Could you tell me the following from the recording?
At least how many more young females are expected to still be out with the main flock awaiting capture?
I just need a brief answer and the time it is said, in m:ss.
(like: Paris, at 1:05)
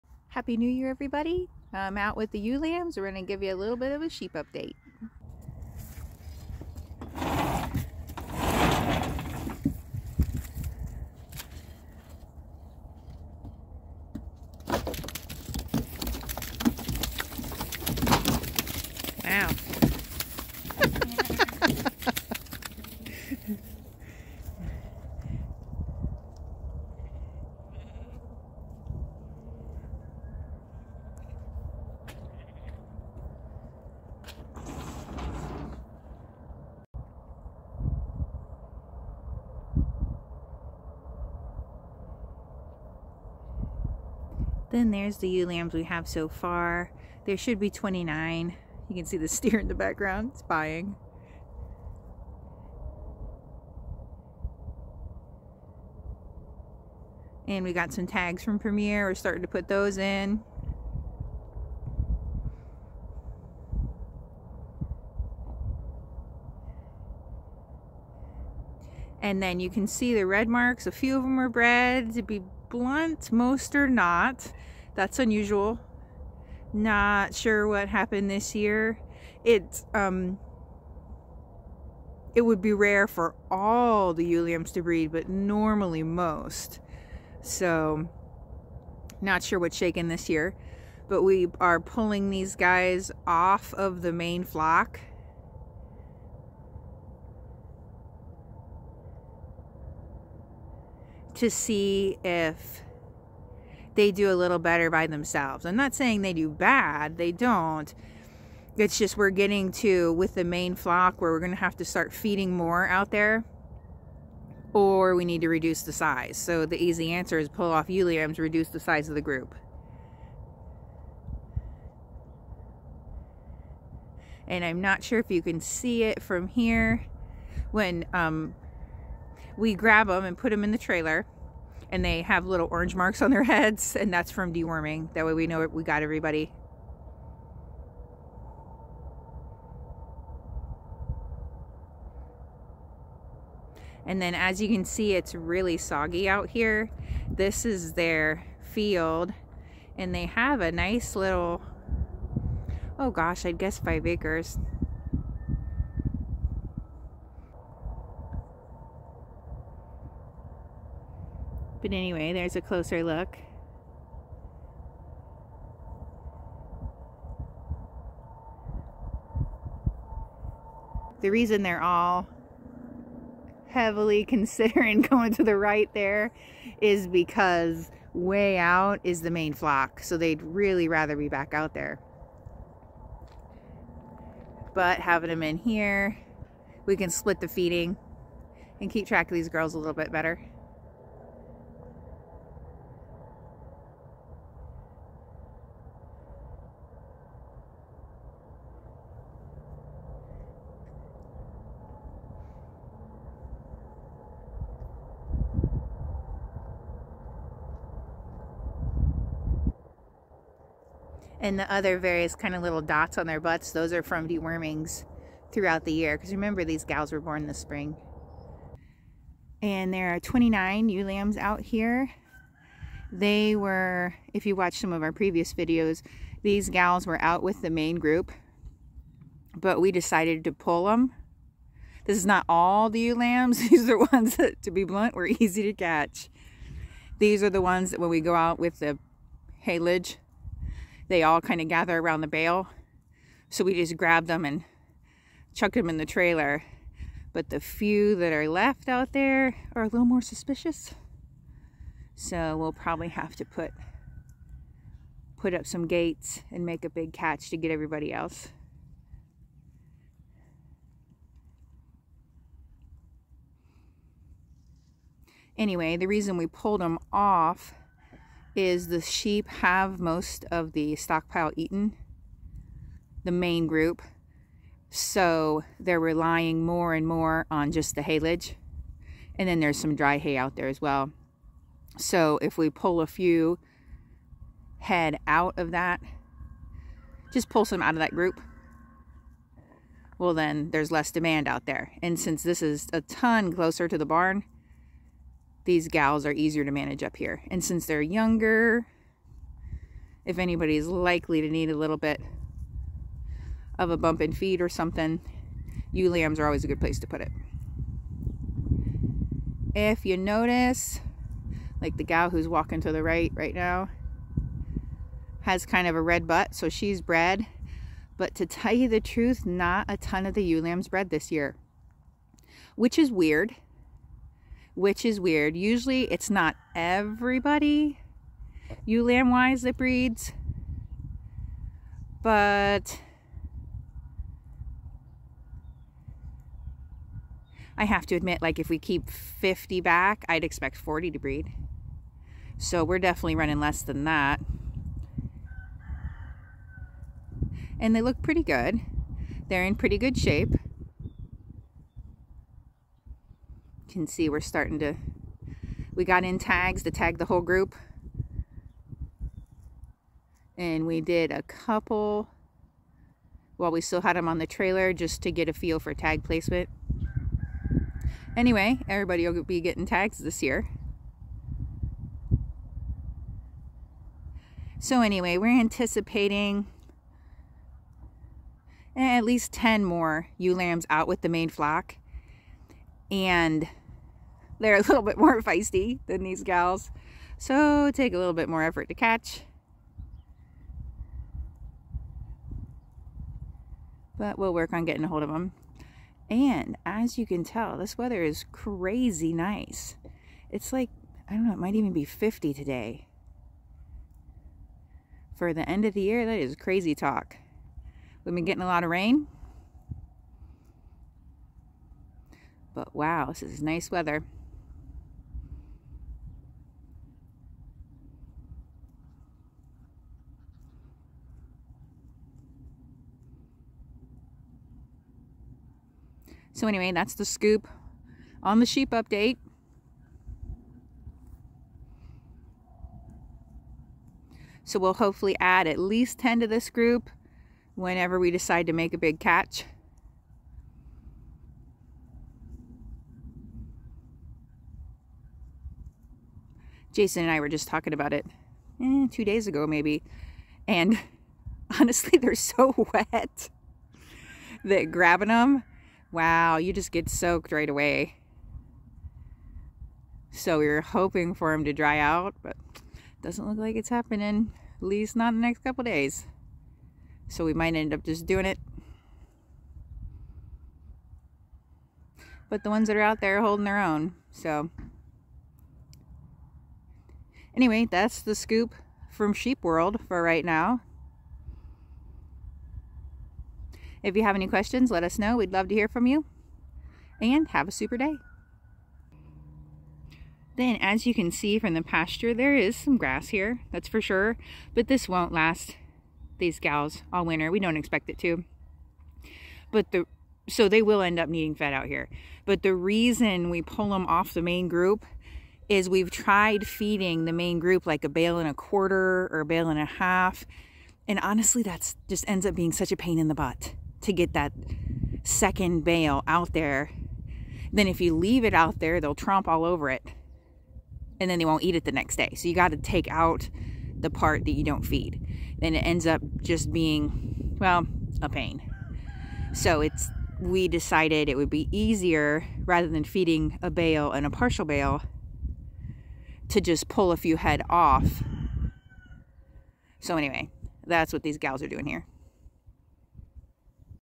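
10, at 6:18.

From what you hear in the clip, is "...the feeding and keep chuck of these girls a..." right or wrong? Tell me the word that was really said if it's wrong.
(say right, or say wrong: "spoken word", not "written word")
wrong: "track", not "chuck".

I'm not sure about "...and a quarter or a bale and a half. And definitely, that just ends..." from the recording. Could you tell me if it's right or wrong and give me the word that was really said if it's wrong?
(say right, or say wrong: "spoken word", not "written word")
wrong: "honestly", not "definitely".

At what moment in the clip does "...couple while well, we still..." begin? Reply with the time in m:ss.
6:01.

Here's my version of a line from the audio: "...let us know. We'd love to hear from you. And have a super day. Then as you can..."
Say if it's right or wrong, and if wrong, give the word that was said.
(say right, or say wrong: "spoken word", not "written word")
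right.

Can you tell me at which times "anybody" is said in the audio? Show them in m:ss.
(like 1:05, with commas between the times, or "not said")
5:00.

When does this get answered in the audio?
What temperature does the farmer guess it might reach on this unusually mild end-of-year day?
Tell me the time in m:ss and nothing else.
6:41.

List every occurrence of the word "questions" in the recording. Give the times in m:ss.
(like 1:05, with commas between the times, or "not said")
8:04.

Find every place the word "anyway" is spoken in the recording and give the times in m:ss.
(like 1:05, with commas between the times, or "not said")
2:41, 4:25, 6:08, 6:15, 7:06, 7:57, 9:00.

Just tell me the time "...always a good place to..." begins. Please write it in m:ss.
5:06.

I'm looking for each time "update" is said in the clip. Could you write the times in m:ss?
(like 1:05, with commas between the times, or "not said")
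0:04, 7:08.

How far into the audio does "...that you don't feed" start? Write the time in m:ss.
8:44.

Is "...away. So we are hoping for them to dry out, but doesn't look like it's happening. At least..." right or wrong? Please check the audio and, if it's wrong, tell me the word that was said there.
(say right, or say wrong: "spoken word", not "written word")
right.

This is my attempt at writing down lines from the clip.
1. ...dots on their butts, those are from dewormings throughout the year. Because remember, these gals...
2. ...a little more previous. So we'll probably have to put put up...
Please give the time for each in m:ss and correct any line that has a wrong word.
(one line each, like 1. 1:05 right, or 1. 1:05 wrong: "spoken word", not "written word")
1. 3:32 right
2. 4:09 wrong: "suspicious", not "previous".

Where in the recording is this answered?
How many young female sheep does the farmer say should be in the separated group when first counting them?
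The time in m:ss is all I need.
0:47.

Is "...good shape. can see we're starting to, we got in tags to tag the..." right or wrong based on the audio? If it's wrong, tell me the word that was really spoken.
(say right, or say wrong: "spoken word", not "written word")
right.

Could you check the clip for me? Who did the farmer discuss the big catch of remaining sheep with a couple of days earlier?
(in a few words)
Jason.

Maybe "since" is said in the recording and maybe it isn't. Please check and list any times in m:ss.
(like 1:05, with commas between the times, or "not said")
4:52, 4:57.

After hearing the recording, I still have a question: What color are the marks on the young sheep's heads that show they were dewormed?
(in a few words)
orange.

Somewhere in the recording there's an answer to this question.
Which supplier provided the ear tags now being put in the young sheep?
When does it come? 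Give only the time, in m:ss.
0:58.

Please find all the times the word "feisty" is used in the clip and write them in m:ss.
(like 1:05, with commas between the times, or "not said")
6:25.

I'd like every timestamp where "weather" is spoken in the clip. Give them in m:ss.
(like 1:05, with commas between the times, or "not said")
6:37, 6:53.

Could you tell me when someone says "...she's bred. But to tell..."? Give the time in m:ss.
5:16.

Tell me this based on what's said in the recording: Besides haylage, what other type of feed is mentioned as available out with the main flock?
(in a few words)
dry hay.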